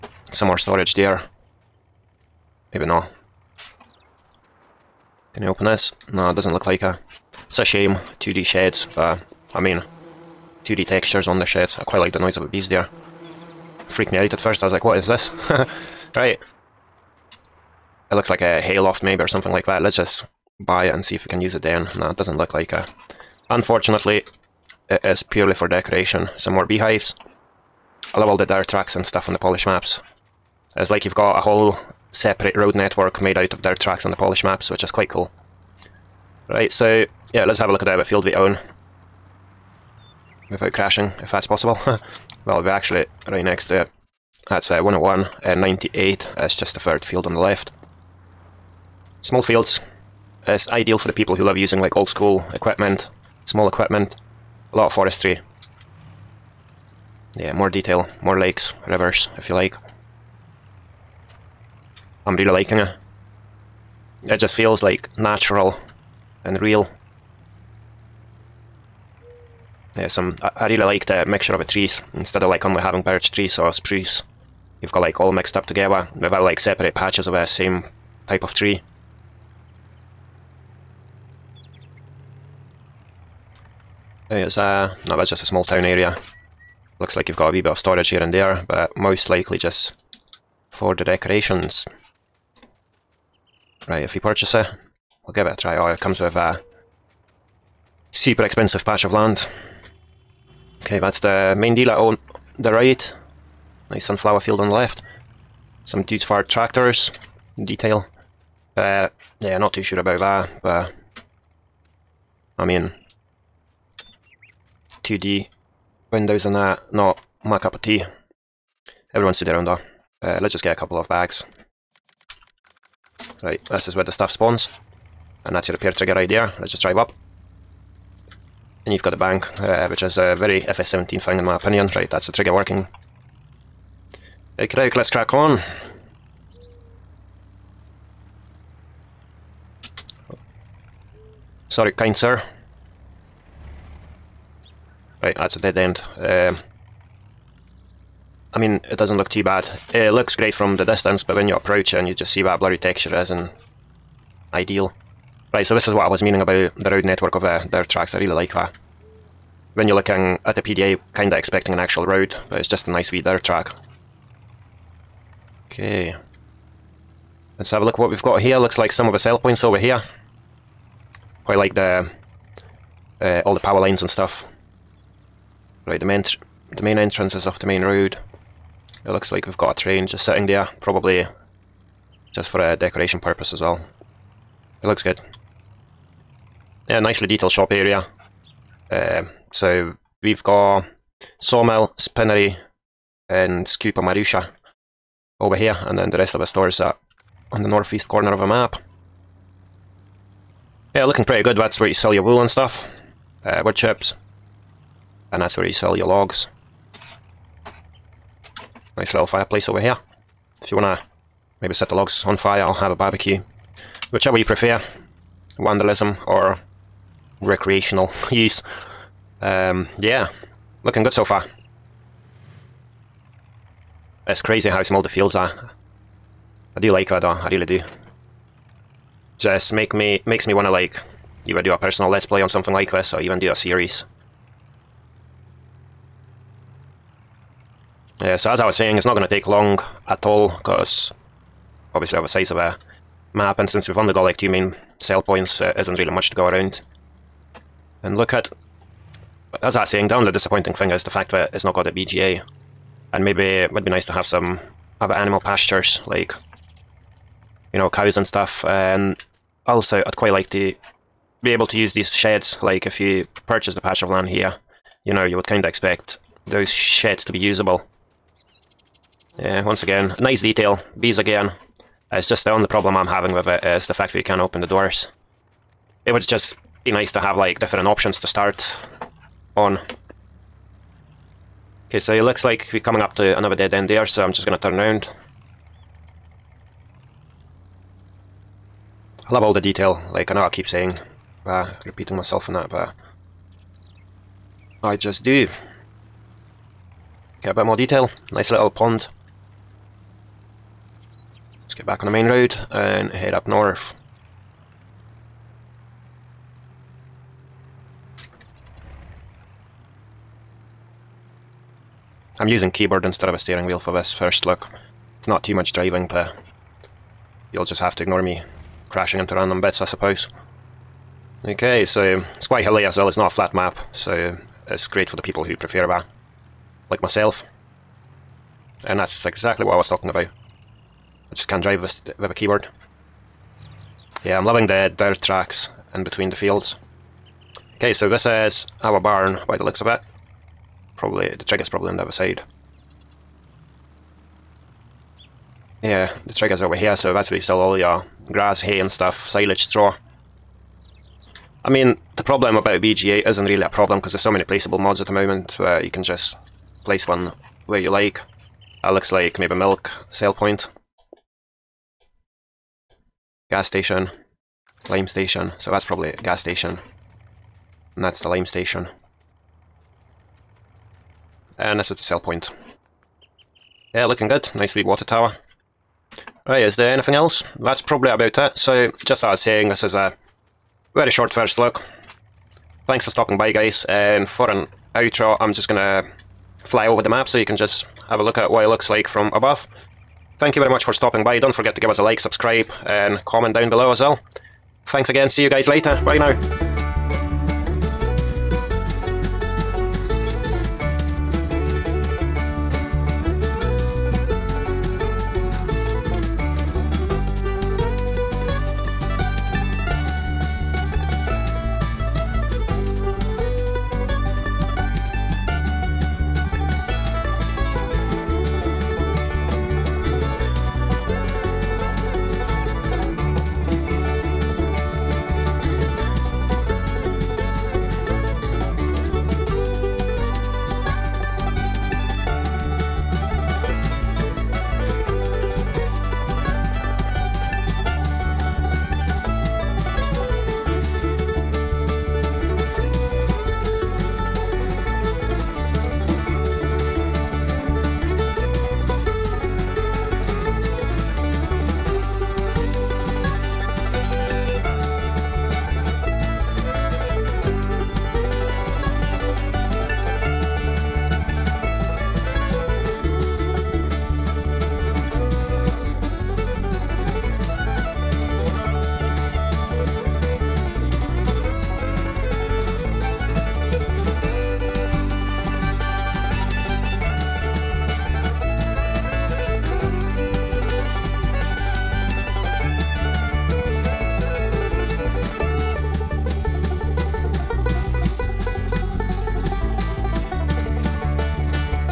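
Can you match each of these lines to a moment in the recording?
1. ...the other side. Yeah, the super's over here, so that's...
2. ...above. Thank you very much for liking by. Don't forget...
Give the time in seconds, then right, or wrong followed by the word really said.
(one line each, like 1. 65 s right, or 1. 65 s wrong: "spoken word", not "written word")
1. 341 s wrong: "trigger", not "super"
2. 389 s wrong: "stopping", not "liking".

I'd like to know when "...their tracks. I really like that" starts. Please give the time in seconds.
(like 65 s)
157 s.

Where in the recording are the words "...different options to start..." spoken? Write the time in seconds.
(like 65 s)
277 s.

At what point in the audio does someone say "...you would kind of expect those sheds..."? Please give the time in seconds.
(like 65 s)
265 s.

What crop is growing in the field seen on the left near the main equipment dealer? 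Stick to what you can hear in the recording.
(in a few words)
Sunflower.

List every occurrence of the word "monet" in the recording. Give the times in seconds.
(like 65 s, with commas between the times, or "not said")
not said.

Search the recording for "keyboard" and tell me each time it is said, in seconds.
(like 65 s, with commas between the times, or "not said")
312 s, 332 s.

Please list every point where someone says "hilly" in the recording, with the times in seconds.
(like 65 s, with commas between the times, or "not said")
322 s.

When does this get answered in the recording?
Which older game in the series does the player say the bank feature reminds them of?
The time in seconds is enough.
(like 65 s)
130 s.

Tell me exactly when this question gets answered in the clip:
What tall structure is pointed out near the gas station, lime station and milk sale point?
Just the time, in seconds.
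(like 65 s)
374 s.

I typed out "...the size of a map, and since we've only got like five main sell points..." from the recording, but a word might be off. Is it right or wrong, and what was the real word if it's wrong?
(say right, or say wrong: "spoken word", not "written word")
wrong: "two", not "five".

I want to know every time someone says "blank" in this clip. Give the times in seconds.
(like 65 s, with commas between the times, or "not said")
not said.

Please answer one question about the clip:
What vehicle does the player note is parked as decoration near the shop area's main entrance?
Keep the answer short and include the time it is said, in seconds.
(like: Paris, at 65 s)
A train, at 179 s.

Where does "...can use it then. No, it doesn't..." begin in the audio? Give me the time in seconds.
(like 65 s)
21 s.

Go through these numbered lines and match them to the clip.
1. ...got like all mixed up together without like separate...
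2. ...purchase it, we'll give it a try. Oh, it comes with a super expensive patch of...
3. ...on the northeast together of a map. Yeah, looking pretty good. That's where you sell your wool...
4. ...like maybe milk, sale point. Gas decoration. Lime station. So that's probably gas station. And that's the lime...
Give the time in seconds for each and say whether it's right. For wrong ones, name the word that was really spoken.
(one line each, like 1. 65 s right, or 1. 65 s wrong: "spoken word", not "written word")
1. 74 s right
2. 94 s right
3. 197 s wrong: "corner", not "together"
4. 359 s wrong: "station", not "decoration".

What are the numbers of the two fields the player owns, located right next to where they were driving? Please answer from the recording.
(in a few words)
101 and 98.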